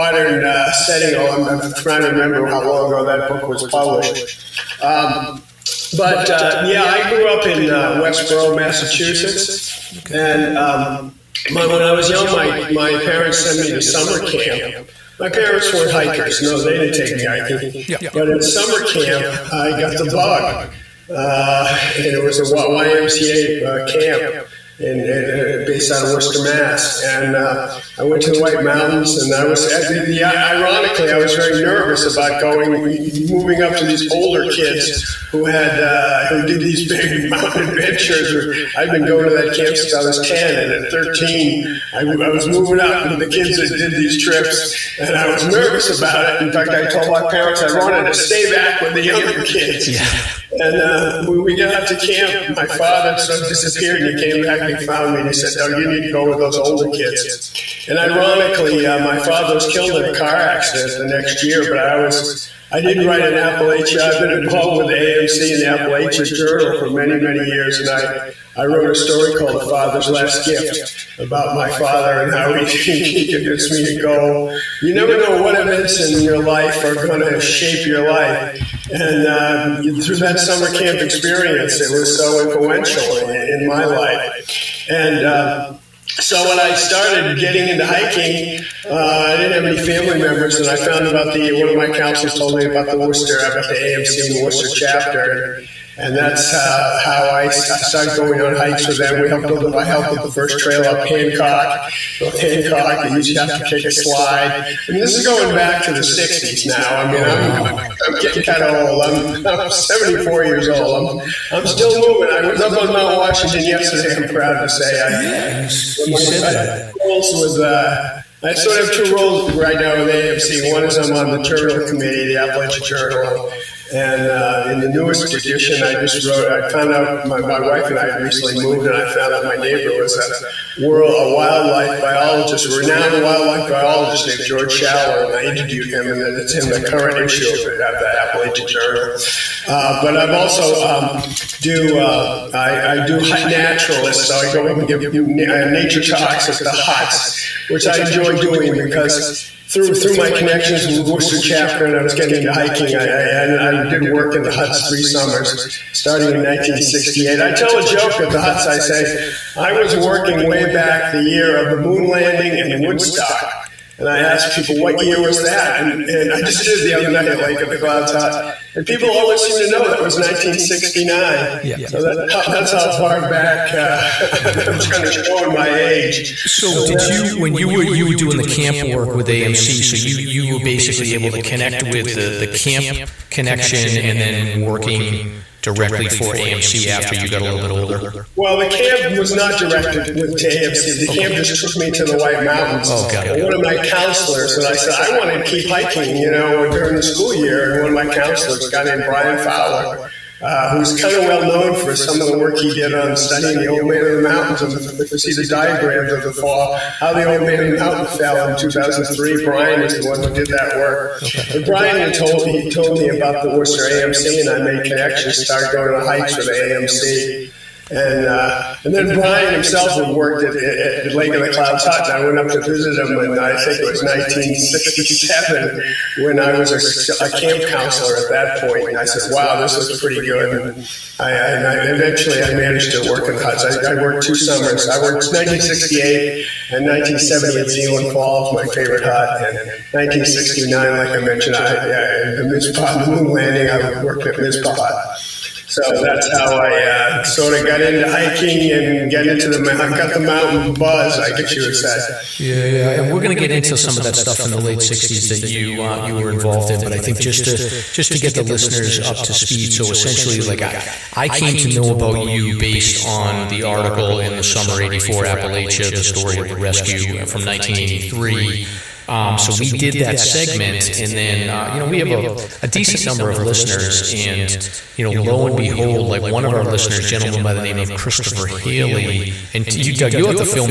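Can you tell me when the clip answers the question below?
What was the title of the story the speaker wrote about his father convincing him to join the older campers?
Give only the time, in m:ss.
1:09.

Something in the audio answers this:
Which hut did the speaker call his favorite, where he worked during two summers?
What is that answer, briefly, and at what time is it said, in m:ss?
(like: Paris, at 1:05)
Zealand Falls, at 3:57.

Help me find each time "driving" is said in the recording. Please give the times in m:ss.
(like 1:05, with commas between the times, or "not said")
not said.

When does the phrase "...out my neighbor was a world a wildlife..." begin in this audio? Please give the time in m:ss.
2:09.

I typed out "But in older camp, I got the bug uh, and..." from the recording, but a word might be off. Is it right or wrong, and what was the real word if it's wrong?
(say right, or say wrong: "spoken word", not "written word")
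wrong: "summer", not "older".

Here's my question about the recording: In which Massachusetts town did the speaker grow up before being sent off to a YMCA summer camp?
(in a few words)
Westboro.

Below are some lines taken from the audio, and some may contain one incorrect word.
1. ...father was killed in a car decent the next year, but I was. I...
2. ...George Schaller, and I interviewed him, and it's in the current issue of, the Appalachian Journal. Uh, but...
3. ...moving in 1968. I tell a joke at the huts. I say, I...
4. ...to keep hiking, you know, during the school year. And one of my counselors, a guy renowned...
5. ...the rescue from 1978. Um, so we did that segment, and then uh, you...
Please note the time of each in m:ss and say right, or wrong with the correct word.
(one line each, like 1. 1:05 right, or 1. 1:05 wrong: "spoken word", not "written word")
1. 0:59 wrong: "accident", not "decent"
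2. 2:14 right
3. 2:35 wrong: "starting", not "moving"
4. 3:15 wrong: "named", not "renowned"
5. 4:26 wrong: "1983", not "1978".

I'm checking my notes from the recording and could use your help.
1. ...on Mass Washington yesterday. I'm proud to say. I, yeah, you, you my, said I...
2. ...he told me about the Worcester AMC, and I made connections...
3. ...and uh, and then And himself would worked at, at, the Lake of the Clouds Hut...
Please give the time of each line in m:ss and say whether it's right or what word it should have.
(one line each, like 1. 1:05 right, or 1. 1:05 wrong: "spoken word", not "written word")
1. 1:52 wrong: "Mount", not "Mass"
2. 3:32 right
3. 3:37 wrong: "Brian", not "And".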